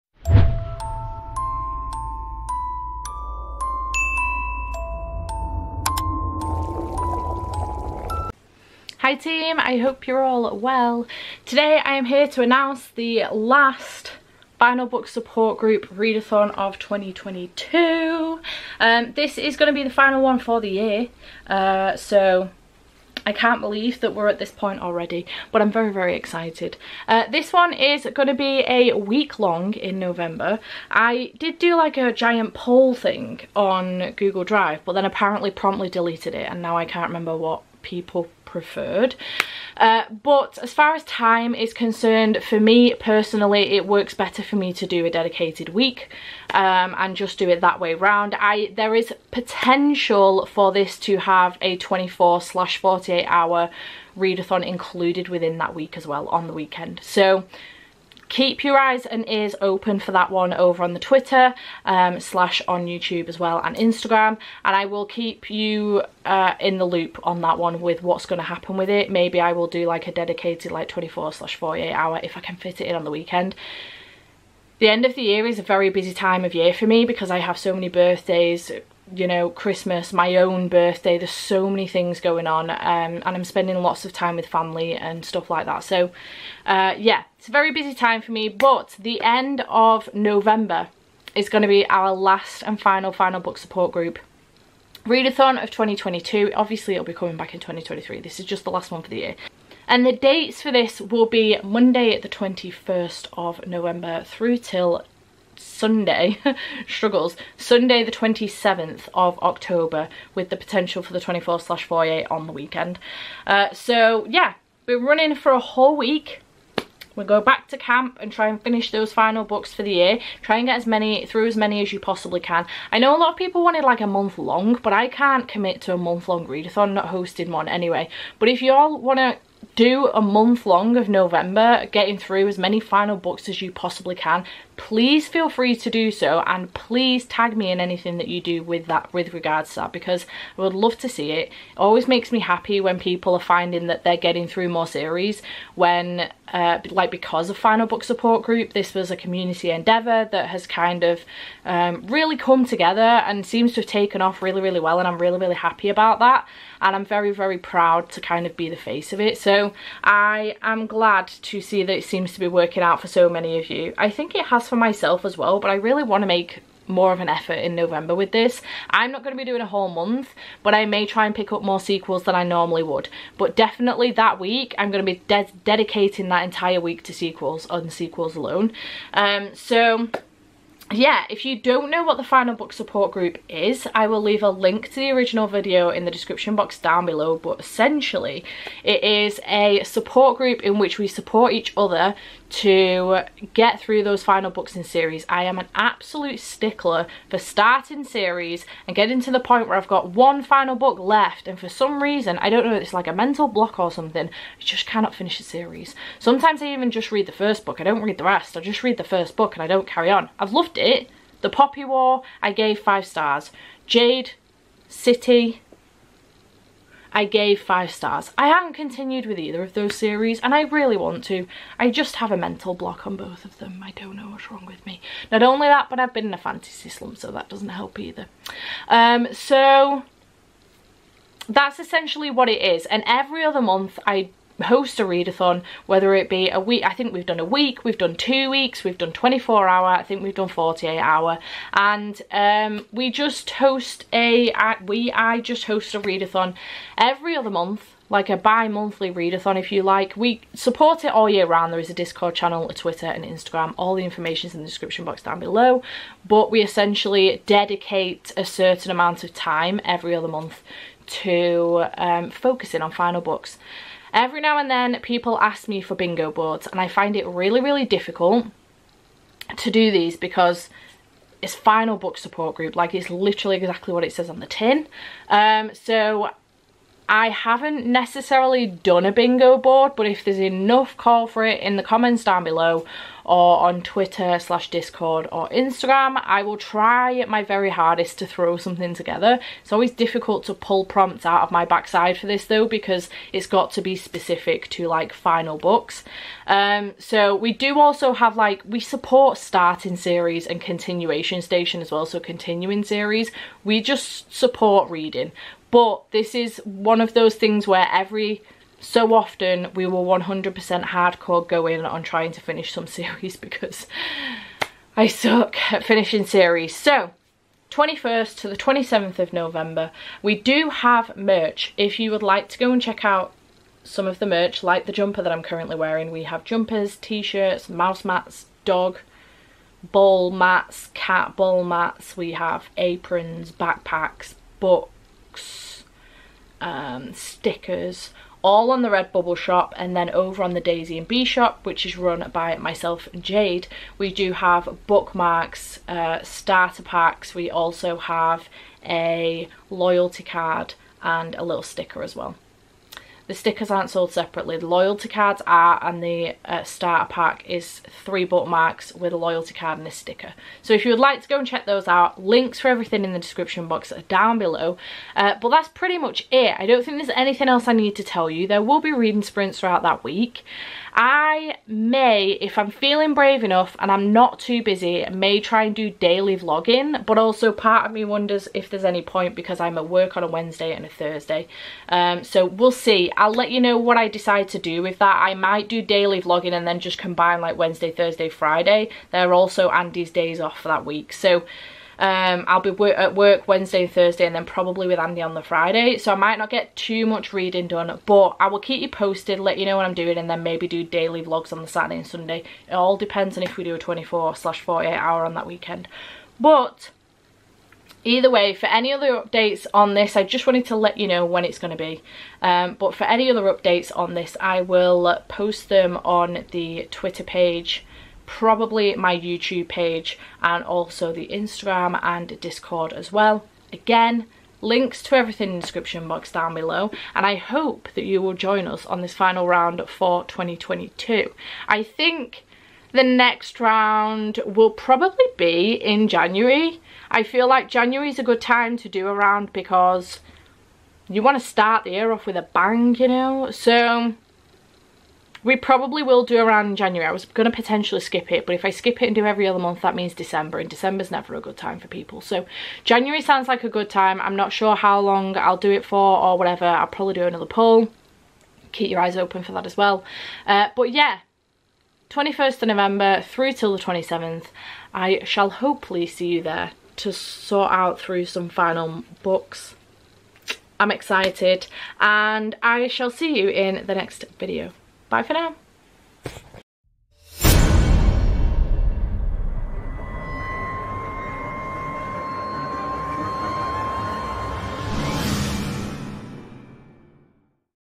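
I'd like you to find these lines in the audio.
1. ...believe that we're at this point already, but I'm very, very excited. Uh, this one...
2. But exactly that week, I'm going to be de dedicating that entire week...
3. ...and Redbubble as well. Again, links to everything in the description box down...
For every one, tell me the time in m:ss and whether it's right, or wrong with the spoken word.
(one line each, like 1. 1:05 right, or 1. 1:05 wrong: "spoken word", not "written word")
1. 0:23 right
2. 2:53 wrong: "definitely", not "exactly"
3. 7:02 wrong: "Discord", not "Redbubble".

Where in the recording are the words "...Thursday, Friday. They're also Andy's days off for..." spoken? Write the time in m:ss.
6:27.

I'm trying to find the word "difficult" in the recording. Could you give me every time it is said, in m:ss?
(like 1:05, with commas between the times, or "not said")
4:27, 4:49.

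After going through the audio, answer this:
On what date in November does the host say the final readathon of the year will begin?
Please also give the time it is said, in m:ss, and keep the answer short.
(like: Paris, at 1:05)
Monday the 21st, at 1:41.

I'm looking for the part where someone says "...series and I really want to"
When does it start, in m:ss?
3:39.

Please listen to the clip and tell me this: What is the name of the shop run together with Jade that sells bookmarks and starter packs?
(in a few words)
Daisie and Bee.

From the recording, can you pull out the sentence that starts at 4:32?
Like it's literally exactly what it says on the tin.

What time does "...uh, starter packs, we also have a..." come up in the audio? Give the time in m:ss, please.
5:45.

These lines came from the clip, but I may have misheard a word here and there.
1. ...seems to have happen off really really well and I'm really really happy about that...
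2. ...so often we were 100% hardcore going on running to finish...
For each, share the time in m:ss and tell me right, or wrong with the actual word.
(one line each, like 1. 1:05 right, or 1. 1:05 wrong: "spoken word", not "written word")
1. 2:33 wrong: "taken", not "happen"
2. 5:08 wrong: "trying", not "running".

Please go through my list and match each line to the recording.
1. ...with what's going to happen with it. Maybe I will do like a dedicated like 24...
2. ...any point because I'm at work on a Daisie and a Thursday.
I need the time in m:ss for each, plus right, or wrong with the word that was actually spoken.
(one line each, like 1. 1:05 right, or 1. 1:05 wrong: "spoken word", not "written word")
1. 1:07 right
2. 6:18 wrong: "Wednesday", not "Daisie".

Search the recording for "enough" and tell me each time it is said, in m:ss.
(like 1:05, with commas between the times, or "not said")
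4:40, 6:13.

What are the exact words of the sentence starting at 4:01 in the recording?
And um, we just host a, we, I just host a readathon every other month like a bi-monthly readathon if you like.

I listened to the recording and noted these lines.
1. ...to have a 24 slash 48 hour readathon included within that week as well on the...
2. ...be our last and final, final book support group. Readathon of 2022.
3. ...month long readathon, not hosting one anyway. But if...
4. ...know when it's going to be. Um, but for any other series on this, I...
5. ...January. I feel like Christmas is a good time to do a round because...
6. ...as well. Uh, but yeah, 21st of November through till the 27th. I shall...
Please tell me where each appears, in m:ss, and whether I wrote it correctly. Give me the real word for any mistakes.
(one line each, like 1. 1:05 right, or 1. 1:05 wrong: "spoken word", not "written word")
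1. 0:50 right
2. 1:31 right
3. 2:05 right
4. 6:51 wrong: "updates", not "series"
5. 7:16 wrong: "January", not "Christmas"
6. 7:39 right.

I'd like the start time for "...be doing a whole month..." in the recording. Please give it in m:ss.
2:49.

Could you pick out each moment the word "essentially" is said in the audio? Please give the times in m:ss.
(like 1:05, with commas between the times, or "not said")
3:07, 3:51, 4:16.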